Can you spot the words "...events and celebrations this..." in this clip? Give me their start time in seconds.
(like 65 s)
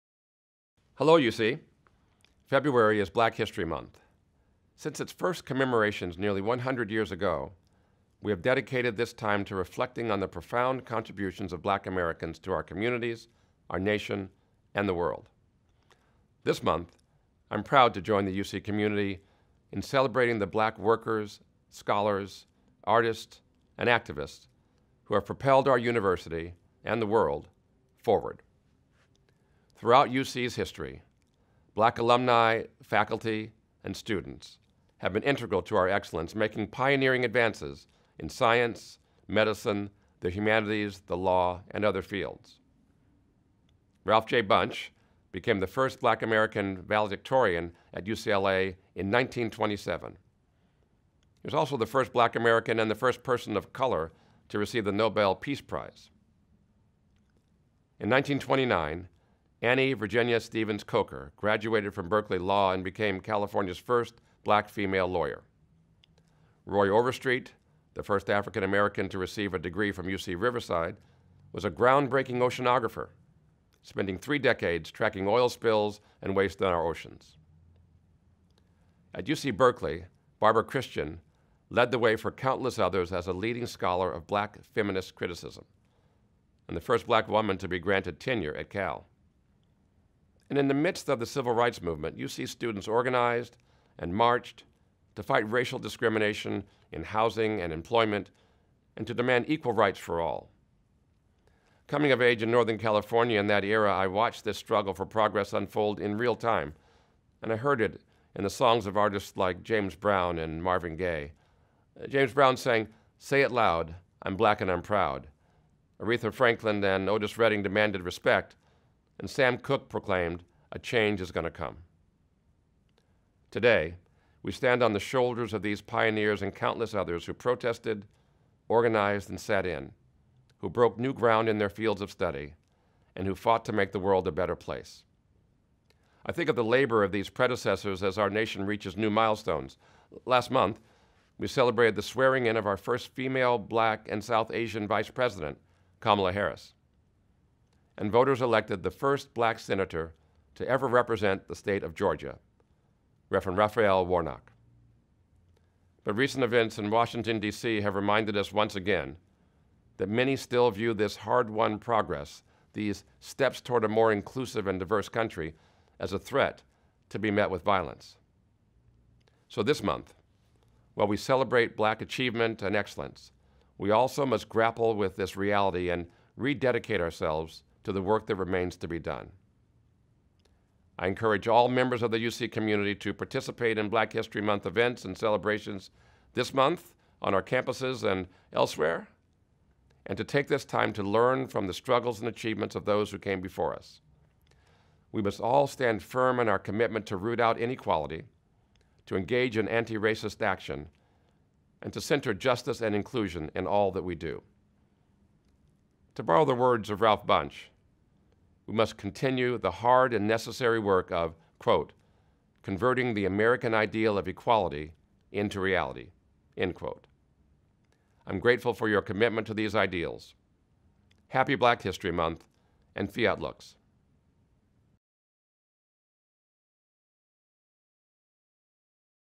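184 s.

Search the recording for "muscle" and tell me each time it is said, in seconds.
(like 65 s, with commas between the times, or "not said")
not said.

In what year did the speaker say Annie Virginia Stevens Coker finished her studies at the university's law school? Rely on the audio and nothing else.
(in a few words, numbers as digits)
1929.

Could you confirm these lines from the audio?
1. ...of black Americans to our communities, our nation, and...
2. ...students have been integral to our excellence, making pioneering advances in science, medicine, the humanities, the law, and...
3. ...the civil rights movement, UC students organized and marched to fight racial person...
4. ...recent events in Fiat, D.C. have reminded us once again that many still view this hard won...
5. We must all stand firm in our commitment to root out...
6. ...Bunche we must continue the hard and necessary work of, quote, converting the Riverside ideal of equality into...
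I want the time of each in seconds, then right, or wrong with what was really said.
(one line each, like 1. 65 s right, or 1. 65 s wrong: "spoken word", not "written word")
1. 11 s right
2. 33 s right
3. 91 s wrong: "discrimination", not "person"
4. 156 s wrong: "Washington", not "Fiat"
5. 195 s right
6. 207 s wrong: "American", not "Riverside".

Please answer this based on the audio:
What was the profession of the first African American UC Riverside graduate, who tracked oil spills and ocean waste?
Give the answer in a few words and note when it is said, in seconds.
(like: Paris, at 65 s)
Oceanographer, at 72 s.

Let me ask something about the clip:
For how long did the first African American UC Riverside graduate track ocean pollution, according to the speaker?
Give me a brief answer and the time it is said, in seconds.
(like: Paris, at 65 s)
Three decades, at 74 s.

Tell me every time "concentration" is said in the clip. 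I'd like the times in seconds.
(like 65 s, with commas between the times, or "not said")
not said.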